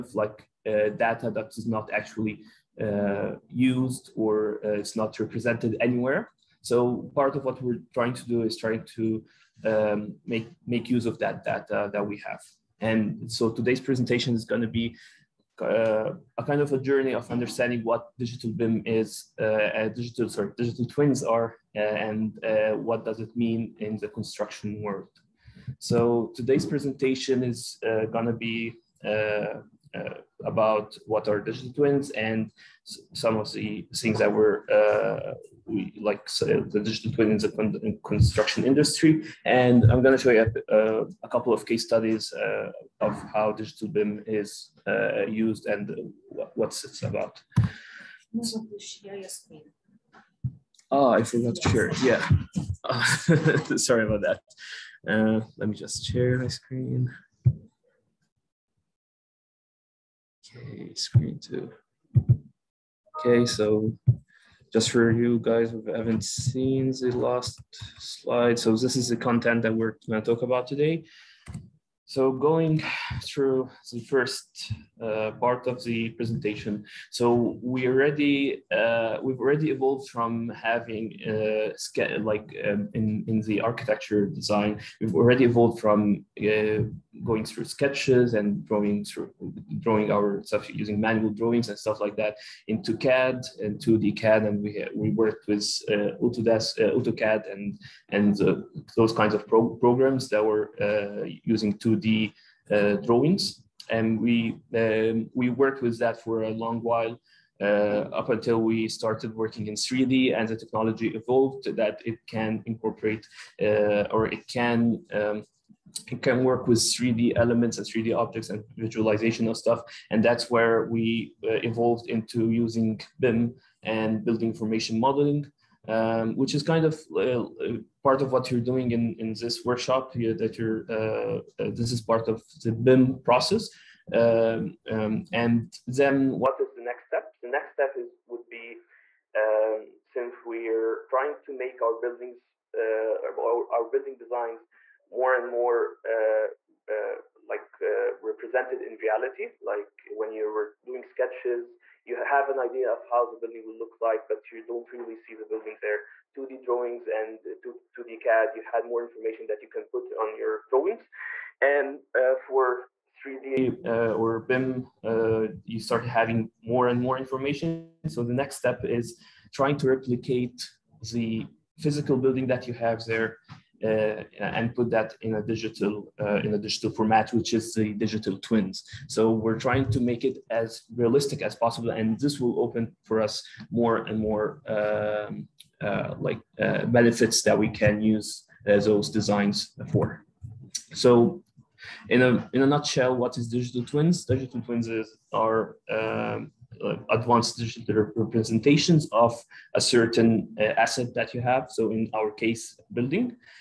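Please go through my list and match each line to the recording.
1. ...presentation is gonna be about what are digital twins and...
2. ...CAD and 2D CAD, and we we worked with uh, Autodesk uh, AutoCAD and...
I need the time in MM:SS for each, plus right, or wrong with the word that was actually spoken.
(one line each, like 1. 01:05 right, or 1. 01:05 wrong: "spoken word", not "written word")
1. 00:26 right
2. 01:32 right.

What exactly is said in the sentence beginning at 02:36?
2D drawings and 2, d CAD, you had more information that you can put on your drawings.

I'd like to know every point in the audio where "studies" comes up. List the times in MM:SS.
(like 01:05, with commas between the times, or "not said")
00:41.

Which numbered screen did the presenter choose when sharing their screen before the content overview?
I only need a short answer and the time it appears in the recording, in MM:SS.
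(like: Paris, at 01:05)
screen two, at 01:00.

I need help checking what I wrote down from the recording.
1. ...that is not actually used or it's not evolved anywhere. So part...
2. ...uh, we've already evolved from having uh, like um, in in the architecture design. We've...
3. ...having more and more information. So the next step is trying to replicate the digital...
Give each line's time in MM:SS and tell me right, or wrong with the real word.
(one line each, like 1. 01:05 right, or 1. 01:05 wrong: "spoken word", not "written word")
1. 00:01 wrong: "represented", not "evolved"
2. 01:18 right
3. 02:46 wrong: "physical", not "digital".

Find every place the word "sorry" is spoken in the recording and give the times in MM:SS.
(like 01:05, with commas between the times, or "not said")
00:20, 00:53.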